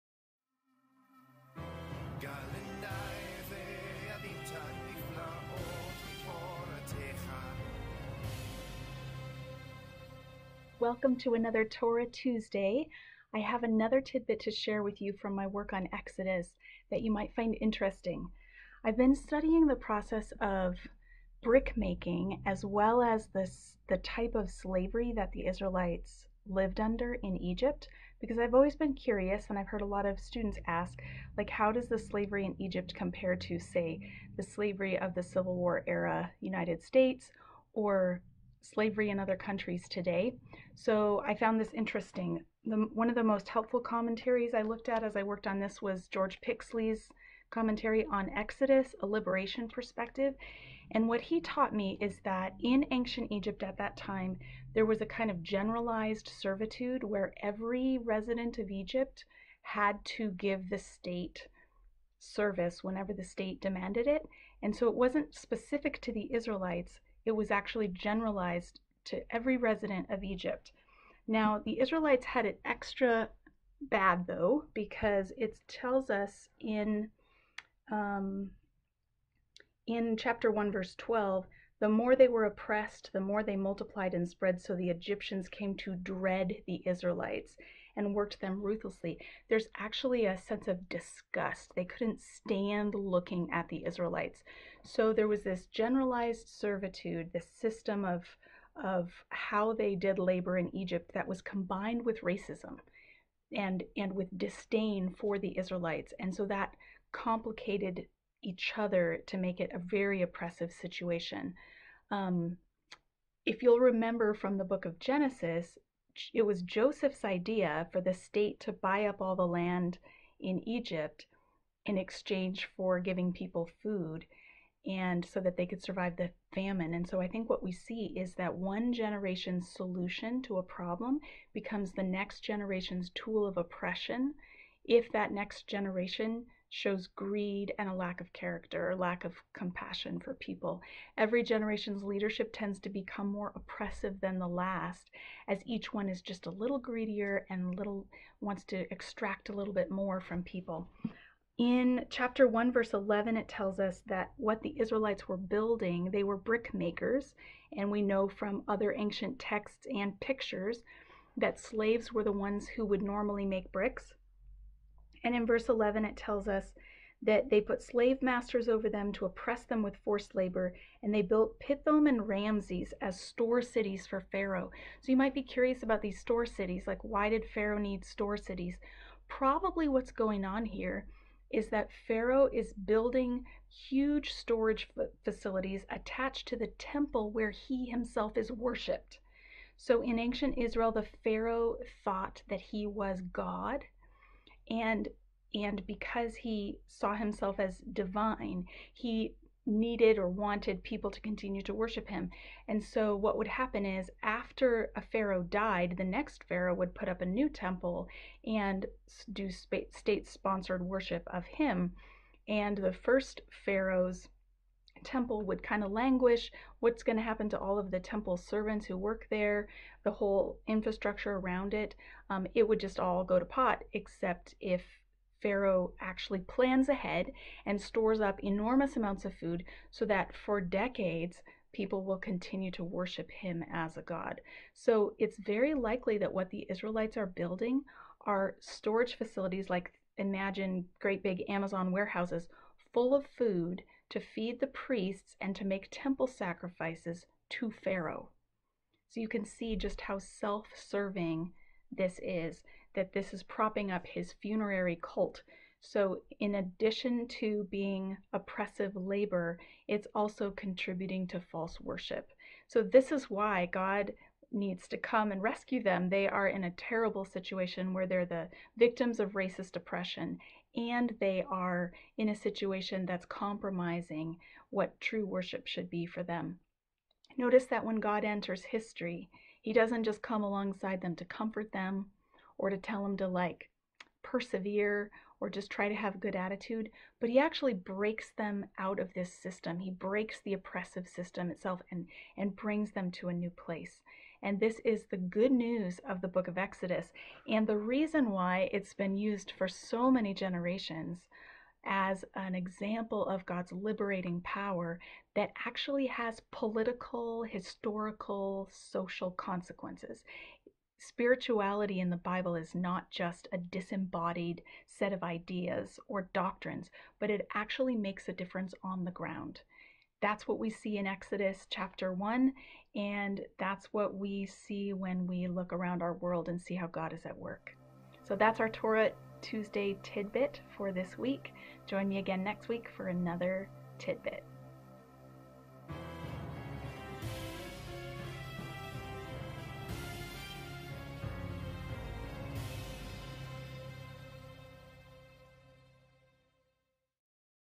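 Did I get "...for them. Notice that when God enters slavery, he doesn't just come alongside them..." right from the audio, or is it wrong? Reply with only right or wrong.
wrong.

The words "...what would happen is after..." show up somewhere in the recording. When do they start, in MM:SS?
03:23.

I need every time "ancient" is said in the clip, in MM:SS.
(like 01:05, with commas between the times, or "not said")
00:52, 02:38, 03:10.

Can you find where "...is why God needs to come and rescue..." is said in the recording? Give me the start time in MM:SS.
04:23.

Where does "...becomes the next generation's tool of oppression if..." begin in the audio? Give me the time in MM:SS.
02:11.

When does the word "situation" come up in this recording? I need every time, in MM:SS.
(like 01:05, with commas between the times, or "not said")
01:50, 04:27, 04:32.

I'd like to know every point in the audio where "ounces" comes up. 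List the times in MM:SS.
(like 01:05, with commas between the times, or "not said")
not said.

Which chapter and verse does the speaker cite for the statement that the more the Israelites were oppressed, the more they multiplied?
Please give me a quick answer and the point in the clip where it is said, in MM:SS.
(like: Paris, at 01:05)
Chapter 1, verse 12, at 01:20.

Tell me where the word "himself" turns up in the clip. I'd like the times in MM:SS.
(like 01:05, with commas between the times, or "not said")
03:07, 03:17.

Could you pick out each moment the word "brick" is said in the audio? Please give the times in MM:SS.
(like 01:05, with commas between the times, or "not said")
00:21, 02:36, 02:43.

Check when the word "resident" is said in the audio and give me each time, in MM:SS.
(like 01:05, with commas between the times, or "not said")
00:57, 01:09.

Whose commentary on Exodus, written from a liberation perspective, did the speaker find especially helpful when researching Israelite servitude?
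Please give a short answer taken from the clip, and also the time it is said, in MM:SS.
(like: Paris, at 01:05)
George Pixley, at 00:46.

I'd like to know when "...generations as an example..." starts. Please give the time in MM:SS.
05:00.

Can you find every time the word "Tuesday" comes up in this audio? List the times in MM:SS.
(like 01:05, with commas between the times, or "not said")
00:12, 05:29.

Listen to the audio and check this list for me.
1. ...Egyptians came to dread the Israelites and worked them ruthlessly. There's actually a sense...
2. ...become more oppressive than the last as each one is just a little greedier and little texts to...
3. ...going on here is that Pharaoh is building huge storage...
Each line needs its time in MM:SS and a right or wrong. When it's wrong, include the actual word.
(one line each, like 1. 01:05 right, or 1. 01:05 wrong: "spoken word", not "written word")
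1. 01:24 right
2. 02:22 wrong: "wants", not "texts"
3. 03:00 right.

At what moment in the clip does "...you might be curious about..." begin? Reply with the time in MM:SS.
02:55.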